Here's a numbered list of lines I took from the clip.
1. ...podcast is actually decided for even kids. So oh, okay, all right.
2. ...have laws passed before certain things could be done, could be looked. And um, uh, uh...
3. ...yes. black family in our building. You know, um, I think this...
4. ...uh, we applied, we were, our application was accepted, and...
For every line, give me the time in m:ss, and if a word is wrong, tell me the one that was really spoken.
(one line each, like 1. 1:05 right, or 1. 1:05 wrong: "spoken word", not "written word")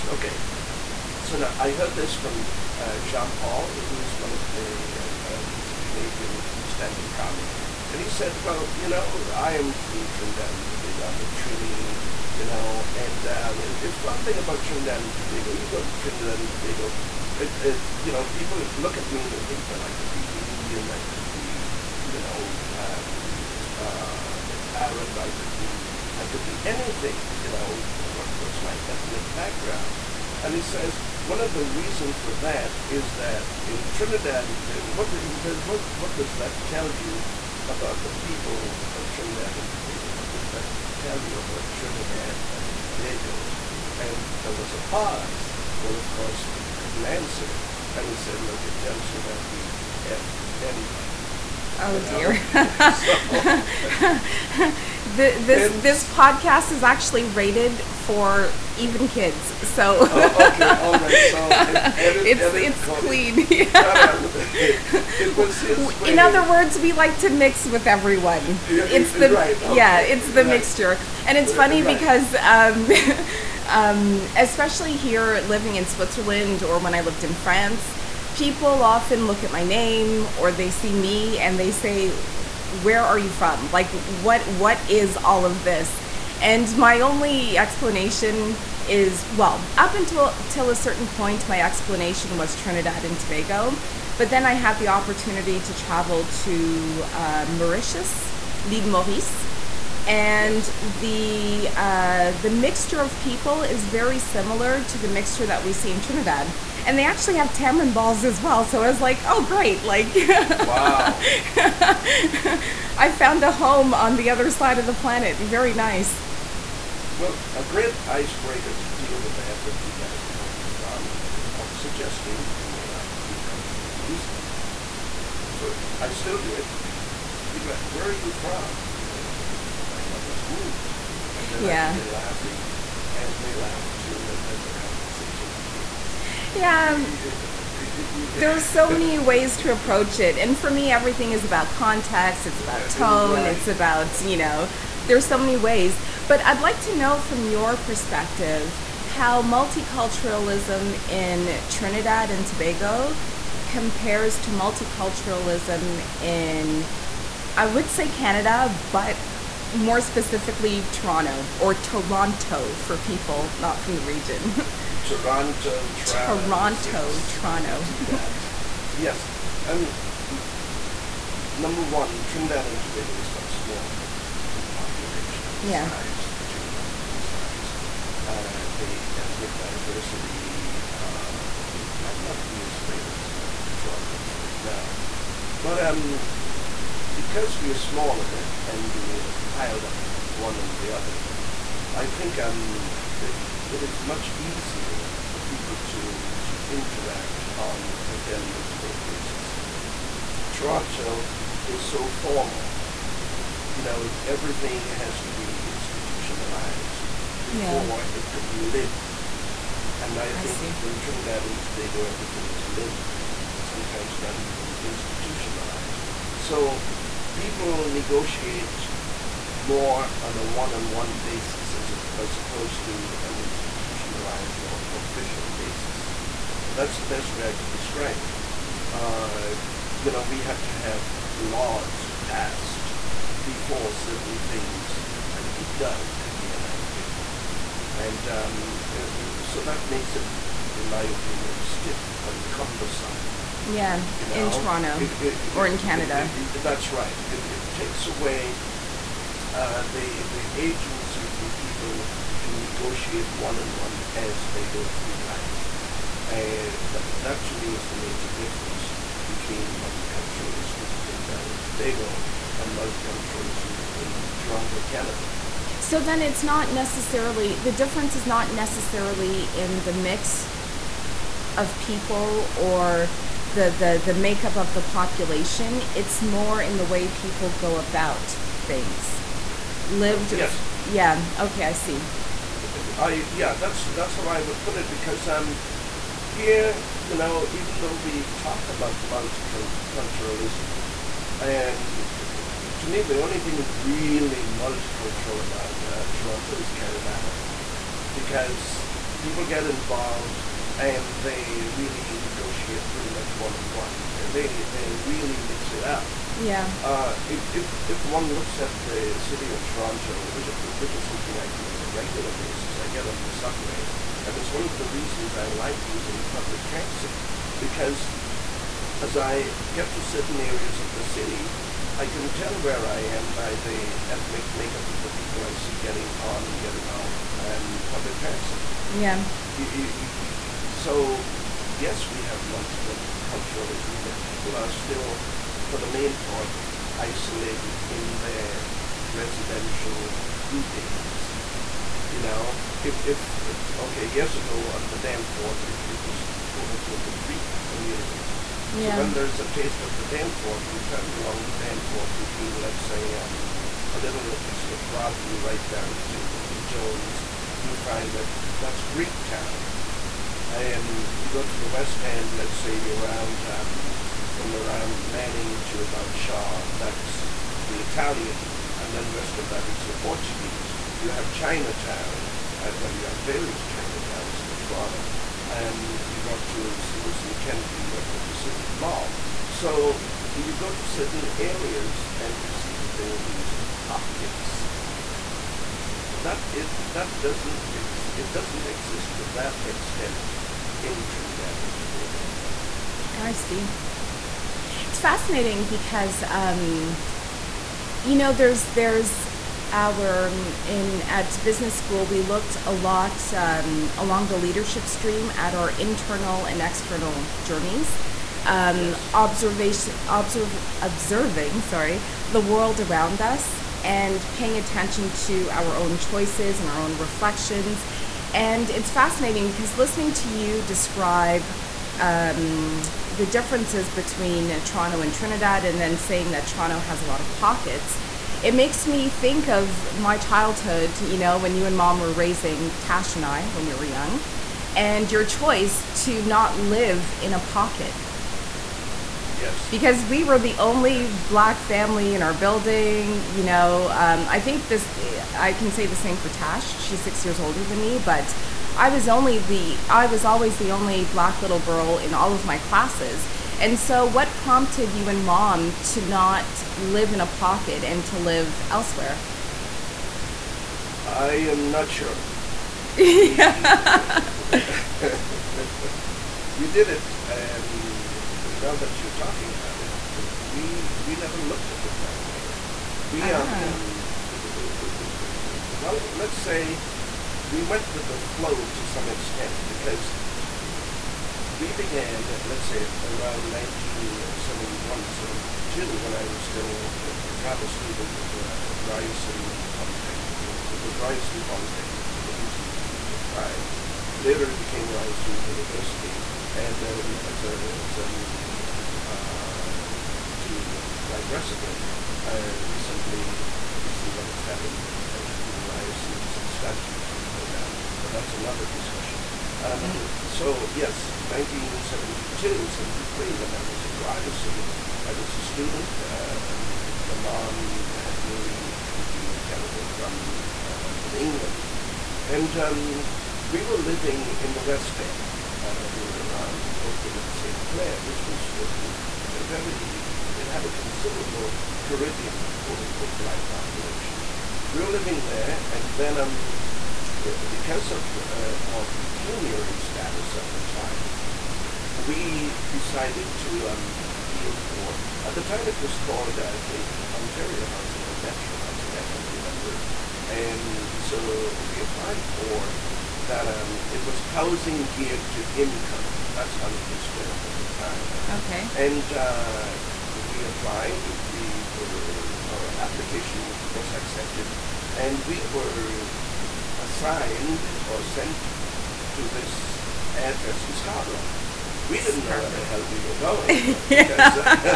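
1. 0:56 wrong: "rated", not "decided"
2. 3:50 wrong: "enacted", not "looked"
3. 7:21 right
4. 9:19 right.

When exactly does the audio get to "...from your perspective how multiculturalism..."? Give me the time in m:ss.
2:27.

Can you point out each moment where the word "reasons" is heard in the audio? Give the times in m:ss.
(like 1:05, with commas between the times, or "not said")
0:31, 5:14.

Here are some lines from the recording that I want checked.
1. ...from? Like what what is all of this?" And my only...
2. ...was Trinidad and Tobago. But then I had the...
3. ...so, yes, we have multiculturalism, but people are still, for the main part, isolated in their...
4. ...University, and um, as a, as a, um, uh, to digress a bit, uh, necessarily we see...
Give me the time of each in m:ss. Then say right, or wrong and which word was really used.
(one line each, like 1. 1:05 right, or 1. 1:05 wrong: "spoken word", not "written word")
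1. 1:23 right
2. 1:32 right
3. 5:30 right
4. 8:15 wrong: "recently", not "necessarily".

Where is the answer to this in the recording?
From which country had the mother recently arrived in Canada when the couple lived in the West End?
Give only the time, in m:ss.
8:41.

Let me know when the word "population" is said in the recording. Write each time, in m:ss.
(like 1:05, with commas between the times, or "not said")
2:54, 4:34, 8:53.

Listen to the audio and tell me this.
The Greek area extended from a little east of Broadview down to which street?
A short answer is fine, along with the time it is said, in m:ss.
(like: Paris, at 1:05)
Jones, at 5:56.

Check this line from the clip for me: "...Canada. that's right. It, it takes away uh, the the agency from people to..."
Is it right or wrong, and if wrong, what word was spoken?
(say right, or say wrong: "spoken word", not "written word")
right.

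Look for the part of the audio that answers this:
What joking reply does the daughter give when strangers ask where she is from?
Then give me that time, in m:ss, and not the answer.
2:09.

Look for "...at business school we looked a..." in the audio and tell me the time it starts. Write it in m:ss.
6:41.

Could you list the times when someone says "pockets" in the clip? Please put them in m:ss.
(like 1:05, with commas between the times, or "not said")
6:23, 7:07, 7:17, 7:37.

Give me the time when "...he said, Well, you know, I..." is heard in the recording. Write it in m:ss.
0:08.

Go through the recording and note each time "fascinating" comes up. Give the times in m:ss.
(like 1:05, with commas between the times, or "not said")
6:34, 6:58.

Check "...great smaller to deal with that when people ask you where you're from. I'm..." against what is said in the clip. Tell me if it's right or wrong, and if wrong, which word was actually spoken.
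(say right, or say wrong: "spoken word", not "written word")
wrong: "icebreaker", not "smaller".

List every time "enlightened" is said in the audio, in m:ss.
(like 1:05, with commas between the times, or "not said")
not said.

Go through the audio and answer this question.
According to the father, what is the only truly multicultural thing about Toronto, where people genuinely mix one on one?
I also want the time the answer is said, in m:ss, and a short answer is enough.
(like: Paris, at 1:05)
Caribana, at 4:56.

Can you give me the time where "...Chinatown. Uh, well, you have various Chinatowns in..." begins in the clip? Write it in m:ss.
6:11.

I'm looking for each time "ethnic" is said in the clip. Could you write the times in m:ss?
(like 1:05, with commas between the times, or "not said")
0:28, 2:59, 5:24.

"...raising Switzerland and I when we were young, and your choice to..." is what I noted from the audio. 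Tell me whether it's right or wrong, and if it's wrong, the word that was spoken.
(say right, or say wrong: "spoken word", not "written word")
wrong: "Tash", not "Switzerland".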